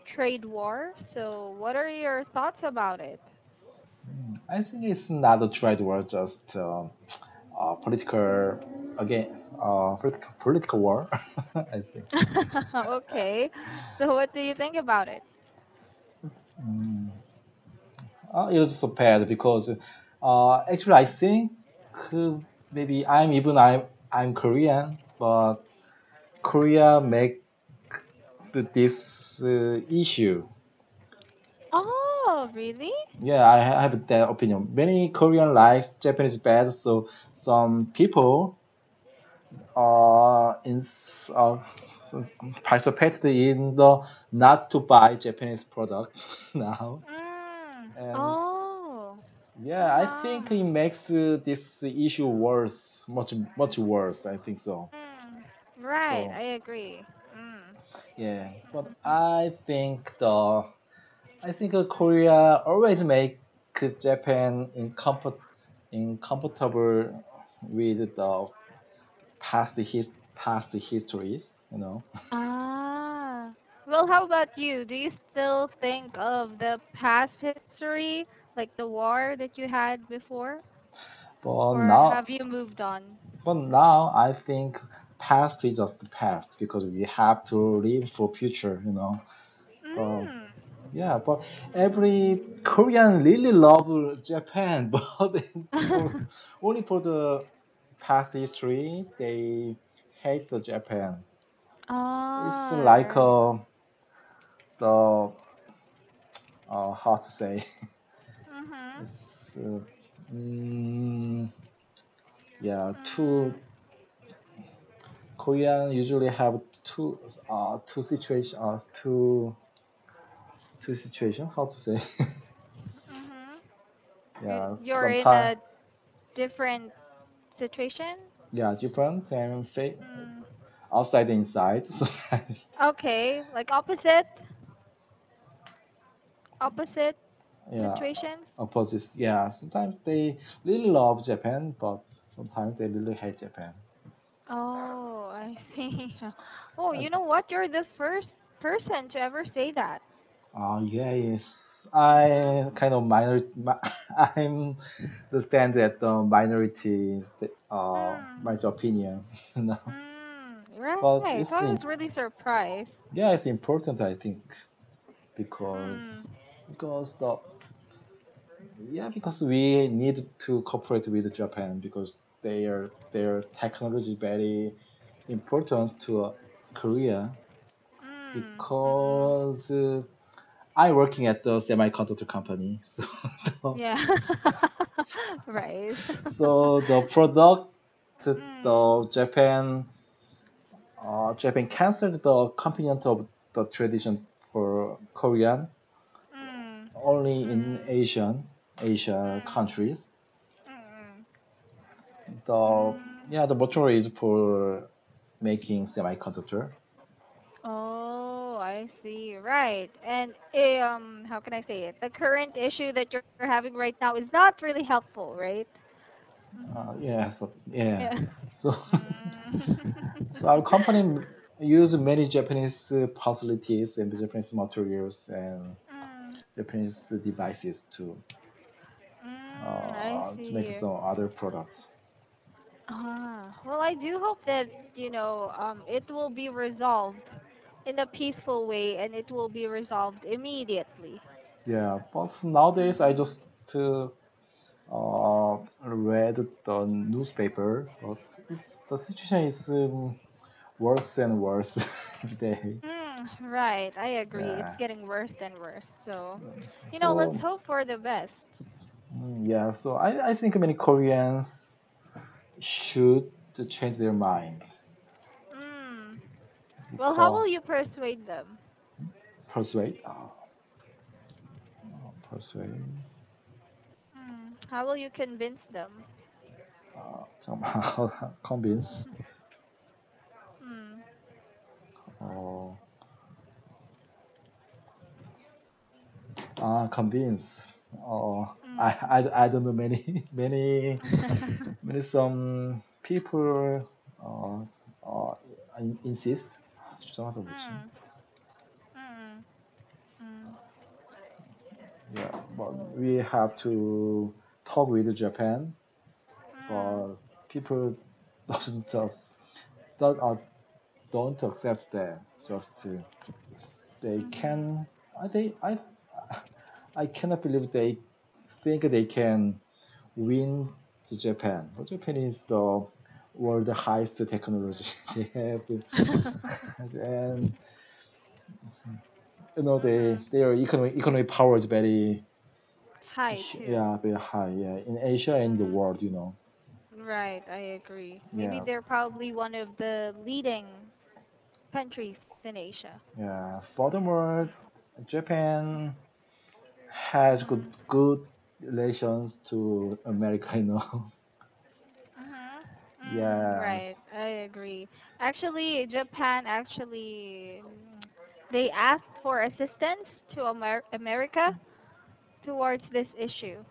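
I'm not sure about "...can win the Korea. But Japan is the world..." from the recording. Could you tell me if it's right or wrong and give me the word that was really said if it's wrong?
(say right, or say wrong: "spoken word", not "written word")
wrong: "Japan", not "Korea".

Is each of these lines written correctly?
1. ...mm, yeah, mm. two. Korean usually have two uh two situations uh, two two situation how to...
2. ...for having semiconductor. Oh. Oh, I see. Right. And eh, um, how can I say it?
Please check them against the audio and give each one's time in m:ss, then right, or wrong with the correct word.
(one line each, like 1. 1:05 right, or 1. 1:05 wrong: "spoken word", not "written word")
1. 1:50 right
2. 3:24 wrong: "making", not "having".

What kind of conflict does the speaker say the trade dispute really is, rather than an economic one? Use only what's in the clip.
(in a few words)
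Political war.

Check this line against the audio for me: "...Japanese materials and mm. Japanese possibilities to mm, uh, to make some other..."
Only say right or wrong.
wrong.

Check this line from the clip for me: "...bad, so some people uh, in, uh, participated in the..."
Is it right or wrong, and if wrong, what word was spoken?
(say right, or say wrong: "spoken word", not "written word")
right.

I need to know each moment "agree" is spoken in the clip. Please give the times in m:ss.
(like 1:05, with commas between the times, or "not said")
0:56, 4:14, 5:37, 5:54.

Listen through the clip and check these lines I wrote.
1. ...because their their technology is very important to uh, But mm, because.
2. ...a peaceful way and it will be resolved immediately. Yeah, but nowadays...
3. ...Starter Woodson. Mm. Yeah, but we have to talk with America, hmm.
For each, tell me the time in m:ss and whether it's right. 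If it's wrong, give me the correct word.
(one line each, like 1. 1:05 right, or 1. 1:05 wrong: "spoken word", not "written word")
1. 2:51 wrong: "Korea", not "But"
2. 3:57 right
3. 4:57 wrong: "Japan", not "America".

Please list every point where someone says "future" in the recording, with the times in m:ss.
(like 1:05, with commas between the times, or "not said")
1:28.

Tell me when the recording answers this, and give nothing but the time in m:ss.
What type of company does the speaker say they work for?
3:01.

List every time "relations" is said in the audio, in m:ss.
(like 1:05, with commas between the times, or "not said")
5:48.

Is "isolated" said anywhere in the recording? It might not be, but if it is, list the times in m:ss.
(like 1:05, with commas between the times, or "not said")
not said.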